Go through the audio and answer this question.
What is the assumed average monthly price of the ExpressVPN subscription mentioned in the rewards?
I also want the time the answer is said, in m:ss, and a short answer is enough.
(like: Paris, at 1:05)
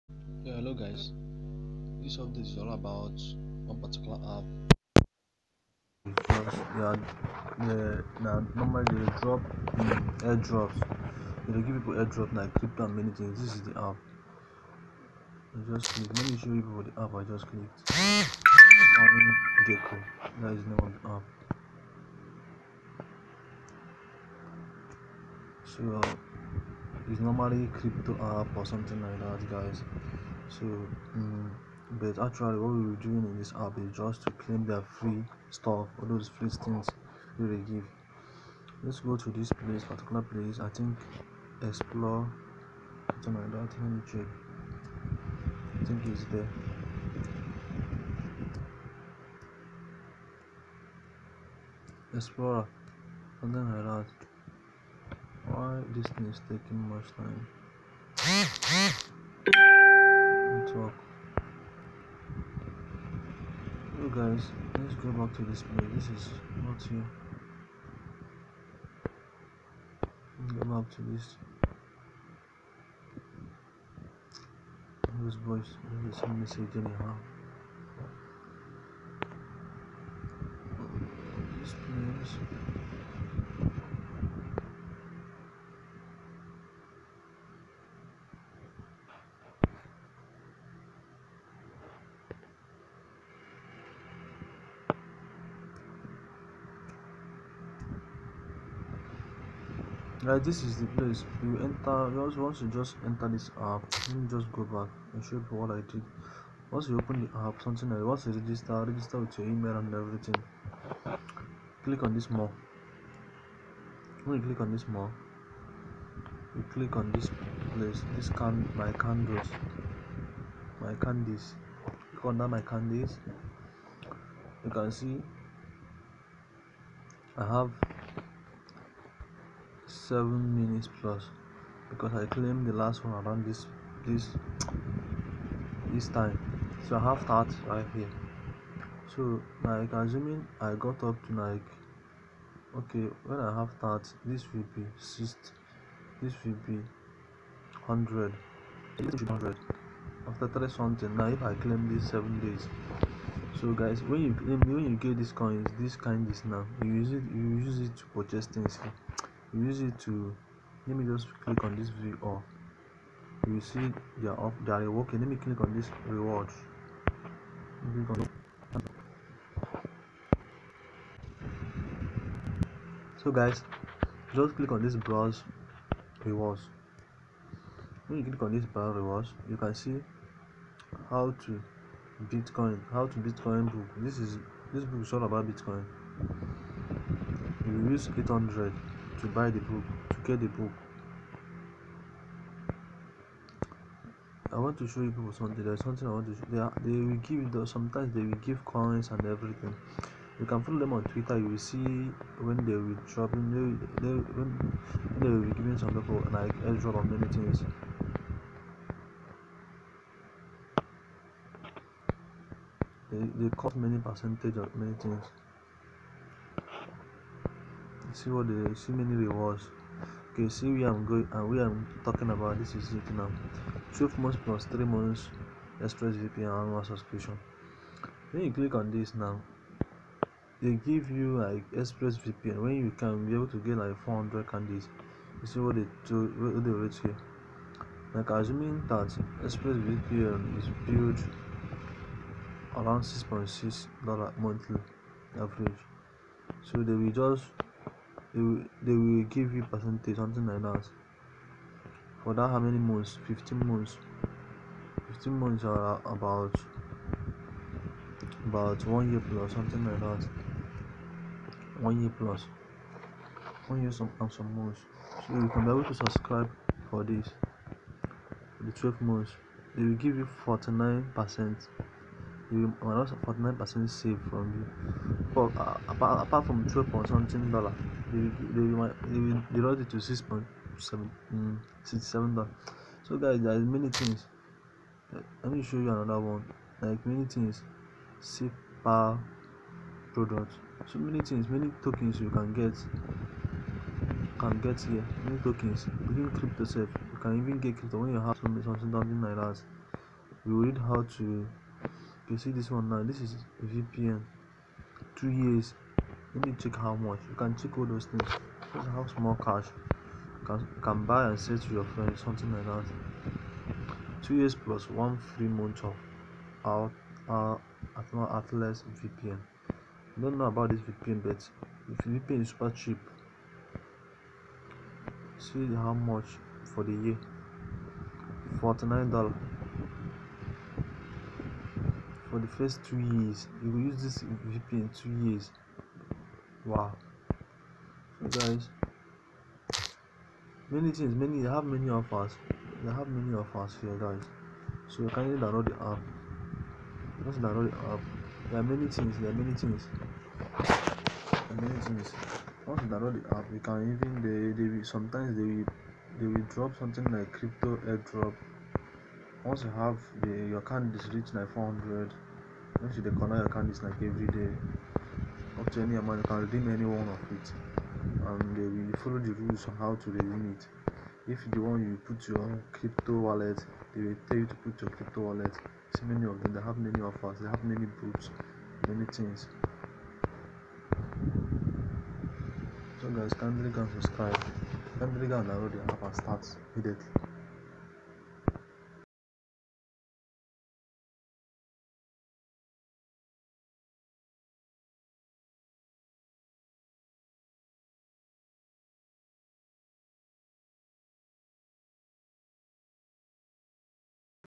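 6.6 dollars, at 4:03.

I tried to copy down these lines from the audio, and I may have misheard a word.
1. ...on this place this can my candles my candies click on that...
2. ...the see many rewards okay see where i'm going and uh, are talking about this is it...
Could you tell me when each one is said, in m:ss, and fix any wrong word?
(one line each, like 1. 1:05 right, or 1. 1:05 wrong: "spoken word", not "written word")
1. 1:56 right
2. 3:38 right.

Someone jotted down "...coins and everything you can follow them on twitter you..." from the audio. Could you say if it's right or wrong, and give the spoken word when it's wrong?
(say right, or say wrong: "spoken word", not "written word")
right.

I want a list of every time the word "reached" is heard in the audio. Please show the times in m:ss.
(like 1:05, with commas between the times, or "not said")
6:01.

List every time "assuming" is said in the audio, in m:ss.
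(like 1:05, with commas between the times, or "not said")
2:19, 3:58.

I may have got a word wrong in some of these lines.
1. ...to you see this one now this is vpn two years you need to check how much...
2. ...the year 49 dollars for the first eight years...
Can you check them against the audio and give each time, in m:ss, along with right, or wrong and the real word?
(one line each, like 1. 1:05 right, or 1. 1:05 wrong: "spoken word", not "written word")
1. 5:01 right
2. 5:26 wrong: "two", not "eight".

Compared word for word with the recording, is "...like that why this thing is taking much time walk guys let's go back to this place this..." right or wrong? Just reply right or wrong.
right.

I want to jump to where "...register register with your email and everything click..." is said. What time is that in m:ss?
1:48.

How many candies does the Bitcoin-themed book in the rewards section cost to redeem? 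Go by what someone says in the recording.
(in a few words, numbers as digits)
800.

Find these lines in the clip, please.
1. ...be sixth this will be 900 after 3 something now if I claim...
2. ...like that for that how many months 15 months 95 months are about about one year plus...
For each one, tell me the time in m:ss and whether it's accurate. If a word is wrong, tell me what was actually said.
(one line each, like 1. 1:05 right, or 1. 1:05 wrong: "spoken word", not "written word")
1. 2:24 wrong: "100", not "900"
2. 4:10 wrong: "15", not "95".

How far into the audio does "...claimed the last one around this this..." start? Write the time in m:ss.
2:12.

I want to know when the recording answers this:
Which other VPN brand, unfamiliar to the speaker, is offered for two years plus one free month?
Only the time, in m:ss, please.
5:18.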